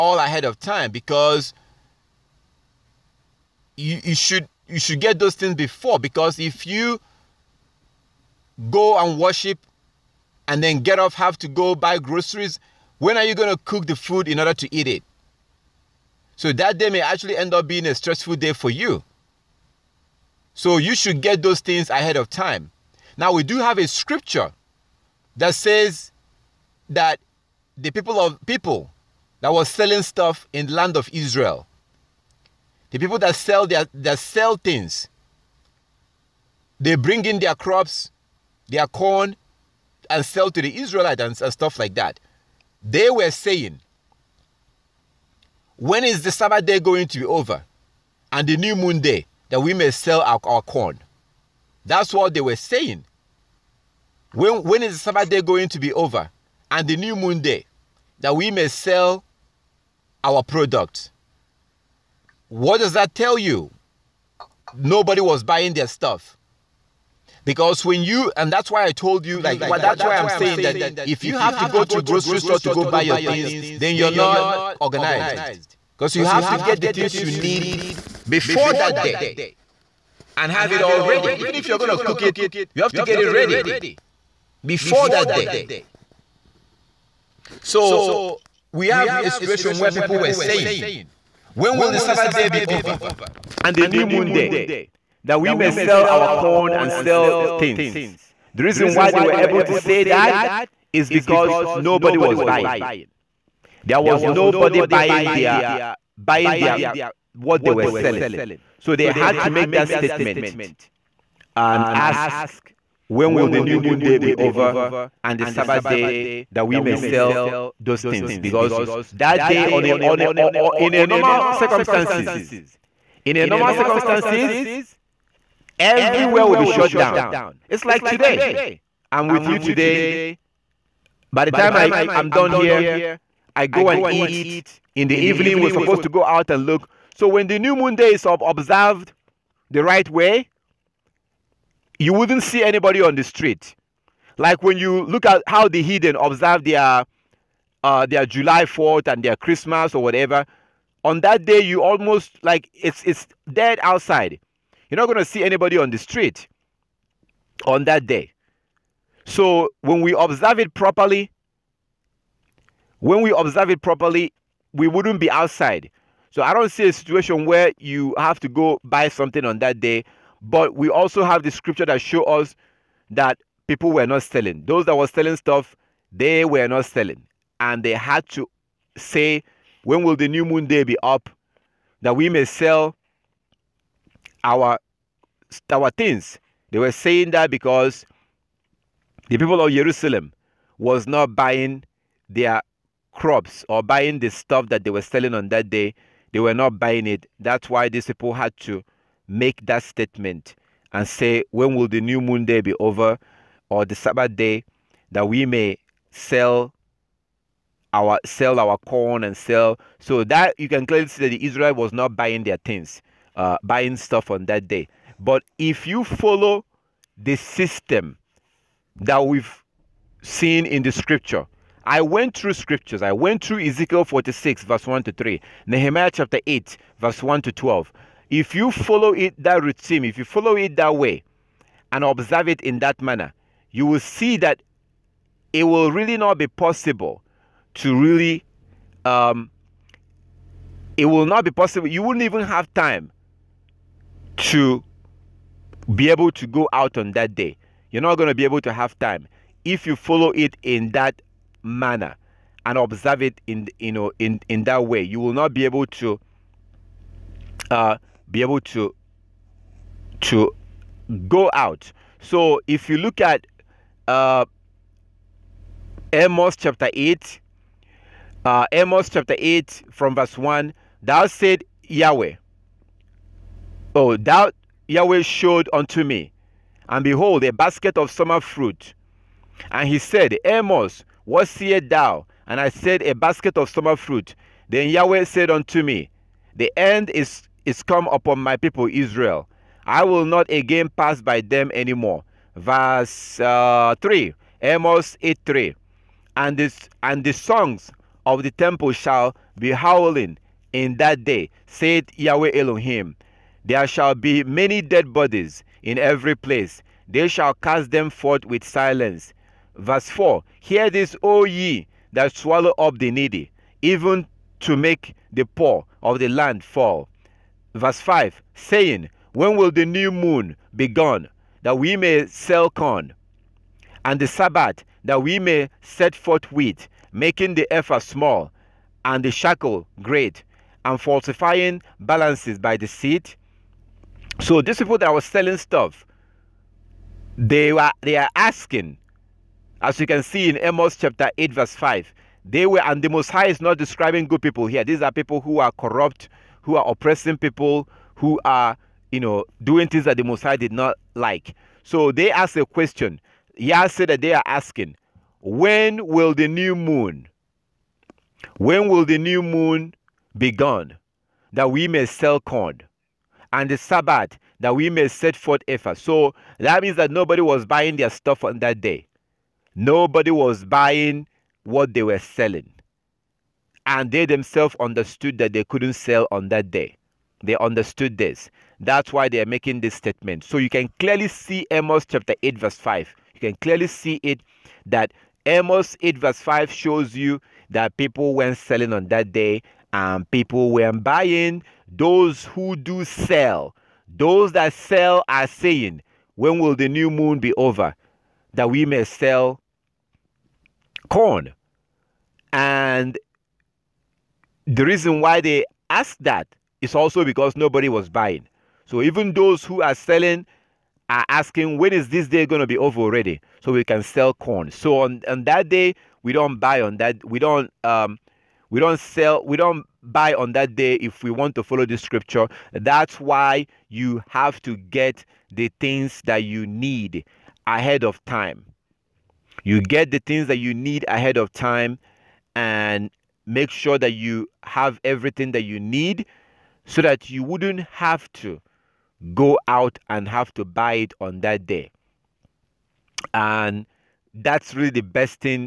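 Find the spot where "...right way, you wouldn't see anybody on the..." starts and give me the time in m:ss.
2:19.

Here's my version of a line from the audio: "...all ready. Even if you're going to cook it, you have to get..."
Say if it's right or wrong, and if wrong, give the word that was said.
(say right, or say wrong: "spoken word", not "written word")
right.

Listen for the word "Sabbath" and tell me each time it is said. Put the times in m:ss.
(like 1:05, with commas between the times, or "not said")
0:46, 0:54, 1:31, 1:55, 3:23, 5:24, 6:03.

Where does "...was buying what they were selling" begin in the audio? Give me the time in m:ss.
6:10.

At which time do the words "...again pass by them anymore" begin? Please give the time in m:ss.
4:50.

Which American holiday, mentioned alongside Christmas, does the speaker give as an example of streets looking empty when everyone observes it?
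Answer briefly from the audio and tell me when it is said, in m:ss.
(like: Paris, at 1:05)
July 4th, at 2:28.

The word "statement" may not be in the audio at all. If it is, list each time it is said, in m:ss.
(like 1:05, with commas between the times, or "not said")
1:49, 3:19, 6:19.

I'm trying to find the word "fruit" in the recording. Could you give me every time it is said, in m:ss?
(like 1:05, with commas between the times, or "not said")
4:38, 4:43.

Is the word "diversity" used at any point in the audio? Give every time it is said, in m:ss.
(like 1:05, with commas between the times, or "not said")
not said.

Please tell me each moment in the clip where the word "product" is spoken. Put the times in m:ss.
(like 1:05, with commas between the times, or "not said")
1:00.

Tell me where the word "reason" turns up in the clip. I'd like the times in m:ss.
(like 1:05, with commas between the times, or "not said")
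1:38, 6:44.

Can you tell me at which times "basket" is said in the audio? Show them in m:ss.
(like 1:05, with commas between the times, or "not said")
4:37, 4:43.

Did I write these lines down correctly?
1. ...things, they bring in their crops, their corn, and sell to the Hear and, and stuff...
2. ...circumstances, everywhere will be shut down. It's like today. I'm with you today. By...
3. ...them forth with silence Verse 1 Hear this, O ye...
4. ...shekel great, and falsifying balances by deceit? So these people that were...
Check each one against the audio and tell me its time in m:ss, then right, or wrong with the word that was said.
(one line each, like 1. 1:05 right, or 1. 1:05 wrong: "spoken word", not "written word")
1. 0:34 wrong: "Israelites", not "Hear"
2. 2:03 right
3. 5:07 wrong: "4", not "1"
4. 5:29 right.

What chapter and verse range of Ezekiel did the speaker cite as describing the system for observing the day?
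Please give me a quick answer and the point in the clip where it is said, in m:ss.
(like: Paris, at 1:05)
46, verses 1 to 3, at 3:43.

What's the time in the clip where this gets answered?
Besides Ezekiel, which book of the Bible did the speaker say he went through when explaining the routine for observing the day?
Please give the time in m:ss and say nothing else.
3:45.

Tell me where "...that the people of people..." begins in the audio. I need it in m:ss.
0:26.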